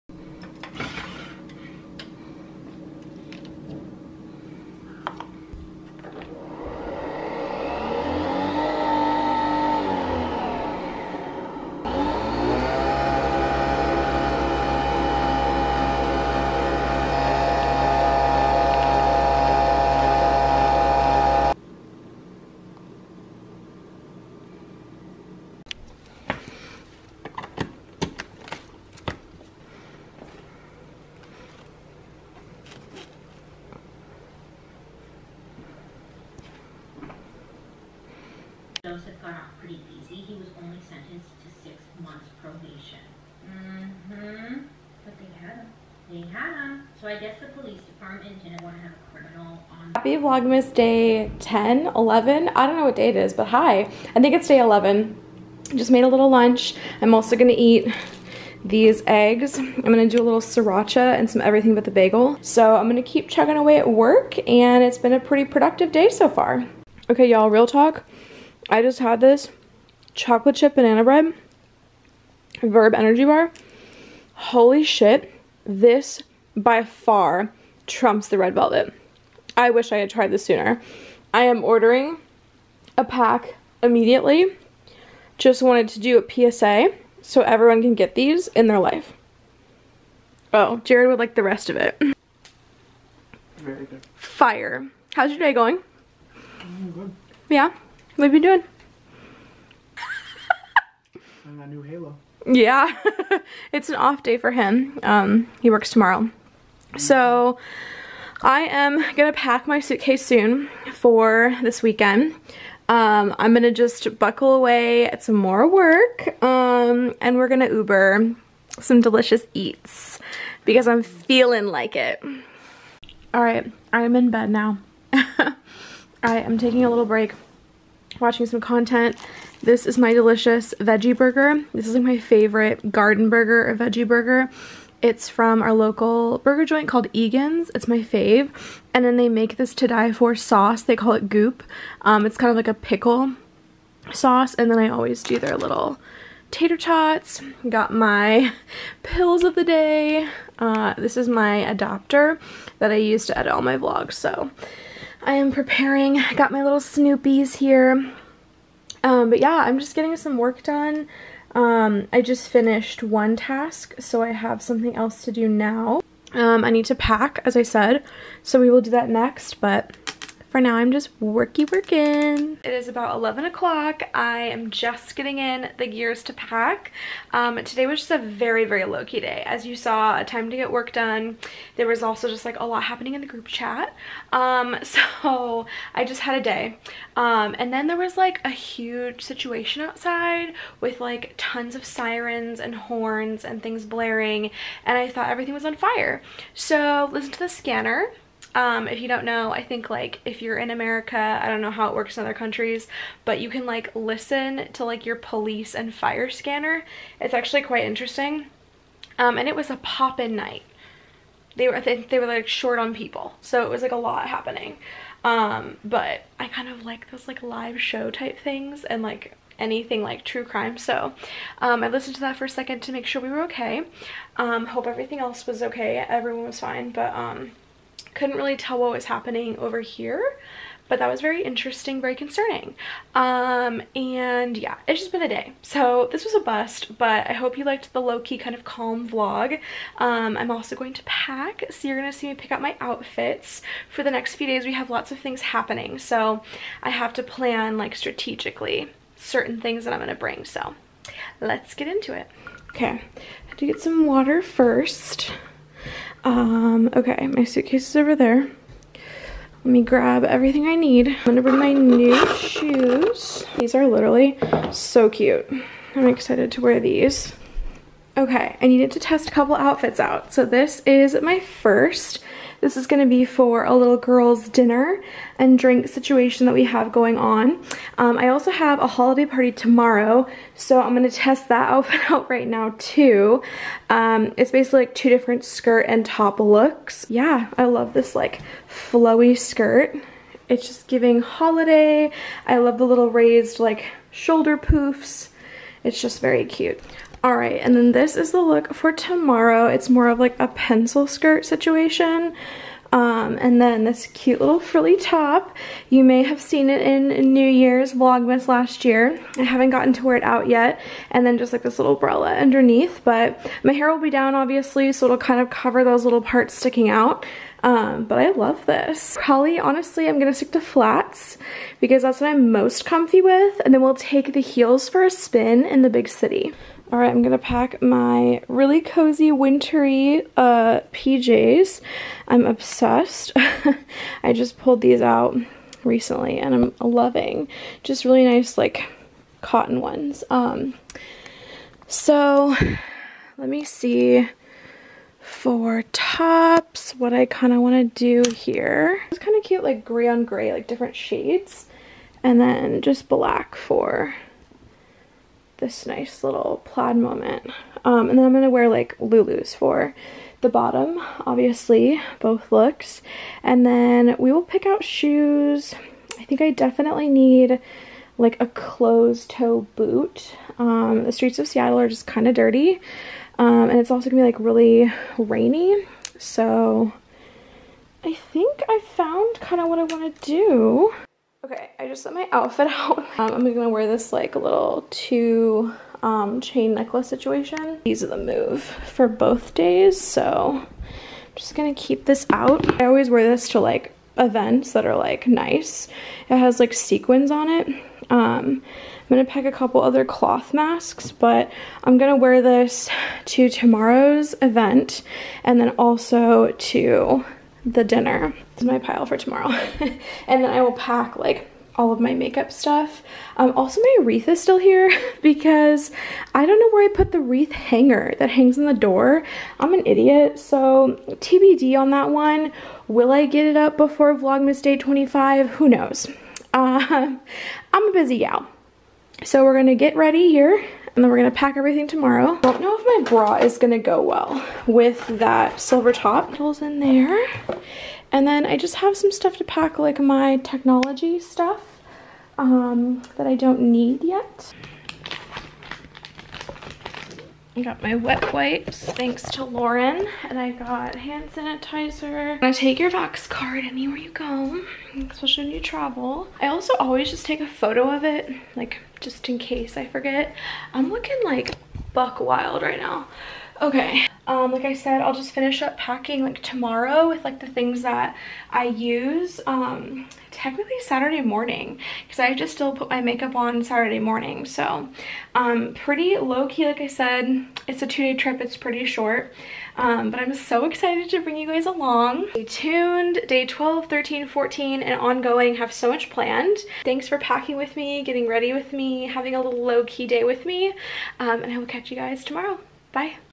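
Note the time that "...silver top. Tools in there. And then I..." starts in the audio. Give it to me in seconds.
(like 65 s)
435 s.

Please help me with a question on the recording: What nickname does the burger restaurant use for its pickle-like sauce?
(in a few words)
Goop.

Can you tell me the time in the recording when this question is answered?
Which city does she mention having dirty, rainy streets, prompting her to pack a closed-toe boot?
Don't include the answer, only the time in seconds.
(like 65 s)
371 s.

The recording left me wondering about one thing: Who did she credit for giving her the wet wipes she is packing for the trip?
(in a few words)
Lauren.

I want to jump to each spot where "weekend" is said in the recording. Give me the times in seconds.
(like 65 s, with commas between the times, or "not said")
111 s.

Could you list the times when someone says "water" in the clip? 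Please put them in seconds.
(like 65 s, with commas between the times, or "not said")
254 s.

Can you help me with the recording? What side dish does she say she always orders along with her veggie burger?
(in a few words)
Tater tots.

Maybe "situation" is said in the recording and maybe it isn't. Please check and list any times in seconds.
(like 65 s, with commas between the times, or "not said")
189 s, 275 s, 301 s, 387 s.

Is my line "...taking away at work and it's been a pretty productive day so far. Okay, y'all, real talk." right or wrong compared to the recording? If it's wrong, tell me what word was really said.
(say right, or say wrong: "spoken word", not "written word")
wrong: "chugging", not "taking".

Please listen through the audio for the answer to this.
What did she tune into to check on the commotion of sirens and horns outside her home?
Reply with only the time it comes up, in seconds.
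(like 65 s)
205 s.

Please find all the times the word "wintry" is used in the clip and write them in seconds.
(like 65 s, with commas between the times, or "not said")
329 s.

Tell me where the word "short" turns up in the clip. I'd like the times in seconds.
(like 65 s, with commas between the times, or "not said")
212 s, 478 s.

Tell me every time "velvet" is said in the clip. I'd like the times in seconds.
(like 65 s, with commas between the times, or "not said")
78 s.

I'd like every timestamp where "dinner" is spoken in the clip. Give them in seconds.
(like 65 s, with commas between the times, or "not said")
274 s, 407 s.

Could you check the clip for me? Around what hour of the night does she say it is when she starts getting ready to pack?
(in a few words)
11 o'clock.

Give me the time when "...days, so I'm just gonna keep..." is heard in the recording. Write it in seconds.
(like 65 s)
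389 s.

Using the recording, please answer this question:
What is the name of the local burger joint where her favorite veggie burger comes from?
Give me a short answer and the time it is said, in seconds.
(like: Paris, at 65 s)
Egan's, at 137 s.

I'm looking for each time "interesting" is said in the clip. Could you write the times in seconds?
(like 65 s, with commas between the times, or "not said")
207 s, 231 s.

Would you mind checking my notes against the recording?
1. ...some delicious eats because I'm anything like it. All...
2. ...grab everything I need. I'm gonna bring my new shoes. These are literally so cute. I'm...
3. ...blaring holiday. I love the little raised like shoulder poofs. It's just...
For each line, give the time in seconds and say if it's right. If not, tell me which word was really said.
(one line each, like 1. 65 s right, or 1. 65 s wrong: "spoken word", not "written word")
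1. 118 s wrong: "feeling", not "anything"
2. 259 s right
3. 290 s wrong: "giving", not "blaring".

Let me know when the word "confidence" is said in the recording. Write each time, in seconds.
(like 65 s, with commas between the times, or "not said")
not said.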